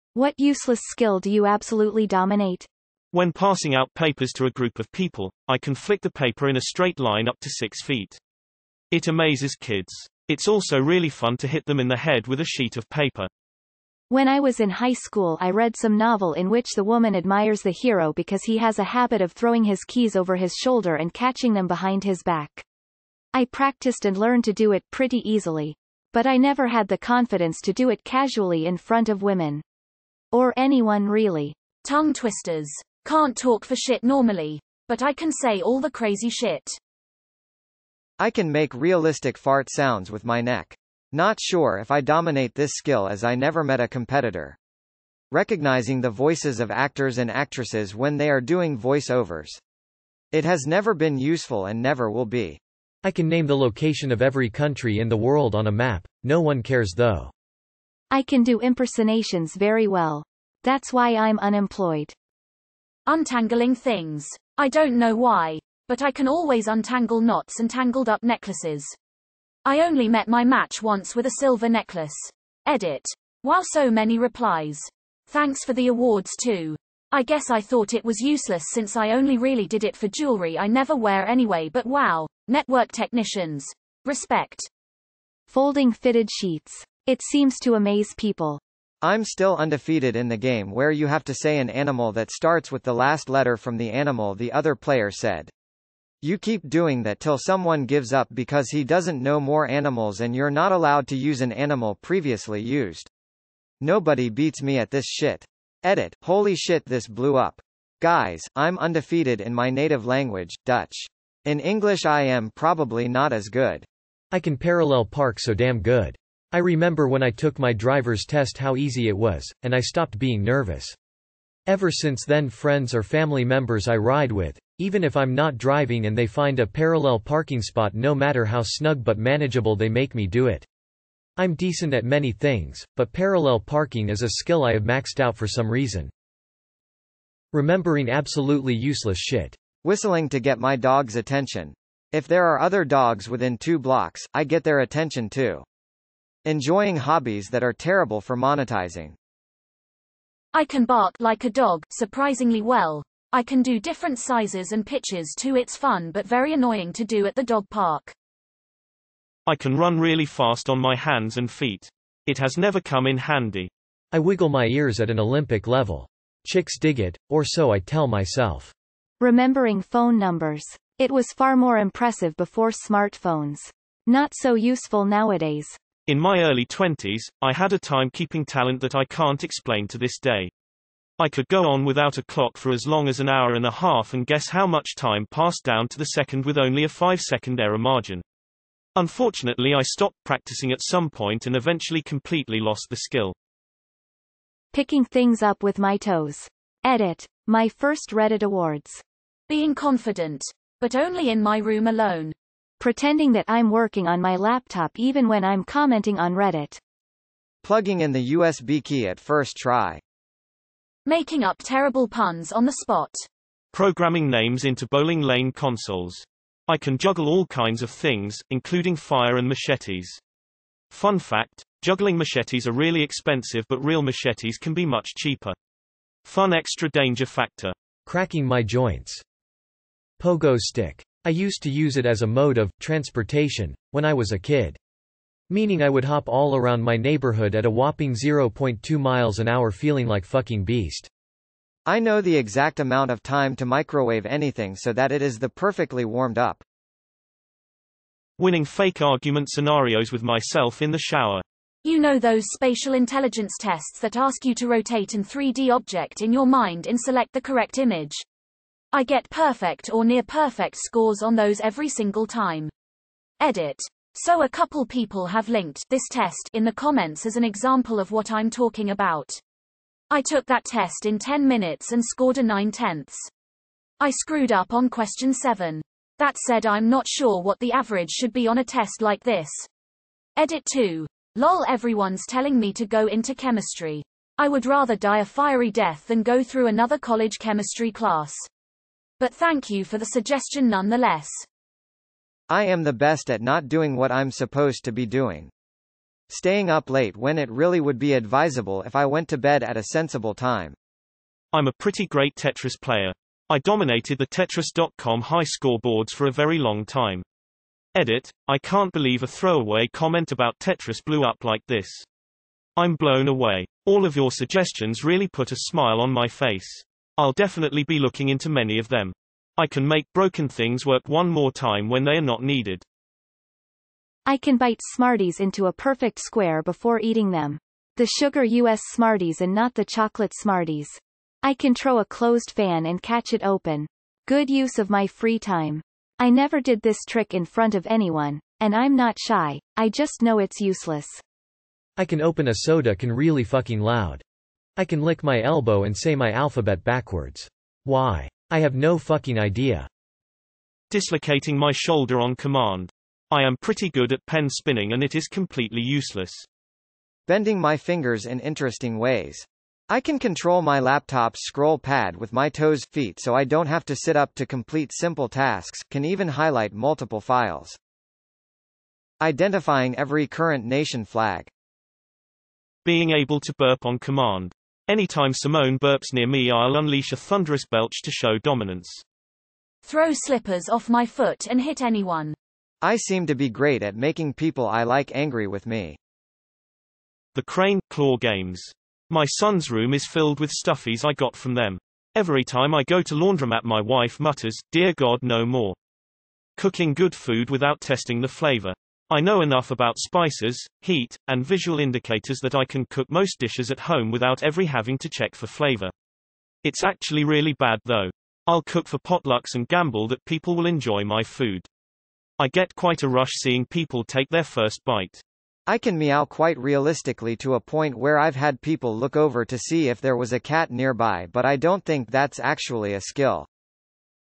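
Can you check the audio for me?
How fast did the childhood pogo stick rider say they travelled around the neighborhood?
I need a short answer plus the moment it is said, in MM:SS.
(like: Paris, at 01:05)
0.2 miles an hour, at 03:58.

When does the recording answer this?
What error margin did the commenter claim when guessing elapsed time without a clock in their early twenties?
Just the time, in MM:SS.
03:06.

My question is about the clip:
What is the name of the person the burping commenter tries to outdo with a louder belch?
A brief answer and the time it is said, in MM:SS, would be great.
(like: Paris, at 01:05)
Simone, at 06:15.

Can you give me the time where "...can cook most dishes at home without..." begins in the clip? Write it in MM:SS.
06:42.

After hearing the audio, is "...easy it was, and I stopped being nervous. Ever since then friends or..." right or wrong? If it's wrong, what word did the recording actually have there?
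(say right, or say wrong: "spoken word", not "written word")
right.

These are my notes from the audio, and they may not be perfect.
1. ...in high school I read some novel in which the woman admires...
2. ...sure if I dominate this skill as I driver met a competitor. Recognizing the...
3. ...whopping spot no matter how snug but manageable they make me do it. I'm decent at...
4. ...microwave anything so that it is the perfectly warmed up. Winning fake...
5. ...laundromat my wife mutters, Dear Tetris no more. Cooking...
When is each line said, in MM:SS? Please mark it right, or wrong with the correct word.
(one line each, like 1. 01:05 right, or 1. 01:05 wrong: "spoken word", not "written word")
1. 00:14 right
2. 00:41 wrong: "never", not "driver"
3. 02:07 wrong: "parking", not "whopping"
4. 04:03 right
5. 06:33 wrong: "God", not "Tetris".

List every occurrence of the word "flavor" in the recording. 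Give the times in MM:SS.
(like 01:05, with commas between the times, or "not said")
06:38, 06:45.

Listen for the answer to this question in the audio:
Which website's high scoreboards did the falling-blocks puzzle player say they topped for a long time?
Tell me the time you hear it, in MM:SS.
05:04.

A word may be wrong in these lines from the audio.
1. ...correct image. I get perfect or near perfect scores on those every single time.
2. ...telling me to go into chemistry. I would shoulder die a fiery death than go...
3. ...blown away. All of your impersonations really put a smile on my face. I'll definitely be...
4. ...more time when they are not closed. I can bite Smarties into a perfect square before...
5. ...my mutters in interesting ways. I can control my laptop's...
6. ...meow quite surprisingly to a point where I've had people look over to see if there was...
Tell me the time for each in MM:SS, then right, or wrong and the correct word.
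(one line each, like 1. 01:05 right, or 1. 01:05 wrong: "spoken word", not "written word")
1. 04:17 right
2. 04:42 wrong: "rather", not "shoulder"
3. 05:12 wrong: "suggestions", not "impersonations"
4. 05:21 wrong: "needed", not "closed"
5. 05:57 wrong: "fingers", not "mutters"
6. 06:55 wrong: "realistically", not "surprisingly".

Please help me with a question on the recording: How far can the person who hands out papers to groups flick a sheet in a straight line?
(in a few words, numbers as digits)
6 feet.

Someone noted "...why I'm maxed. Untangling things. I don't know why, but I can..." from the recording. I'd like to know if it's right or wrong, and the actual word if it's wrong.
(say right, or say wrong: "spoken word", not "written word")
wrong: "unemployed", not "maxed".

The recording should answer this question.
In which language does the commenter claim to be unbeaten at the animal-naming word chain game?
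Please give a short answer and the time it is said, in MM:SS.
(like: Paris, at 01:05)
Dutch, at 01:50.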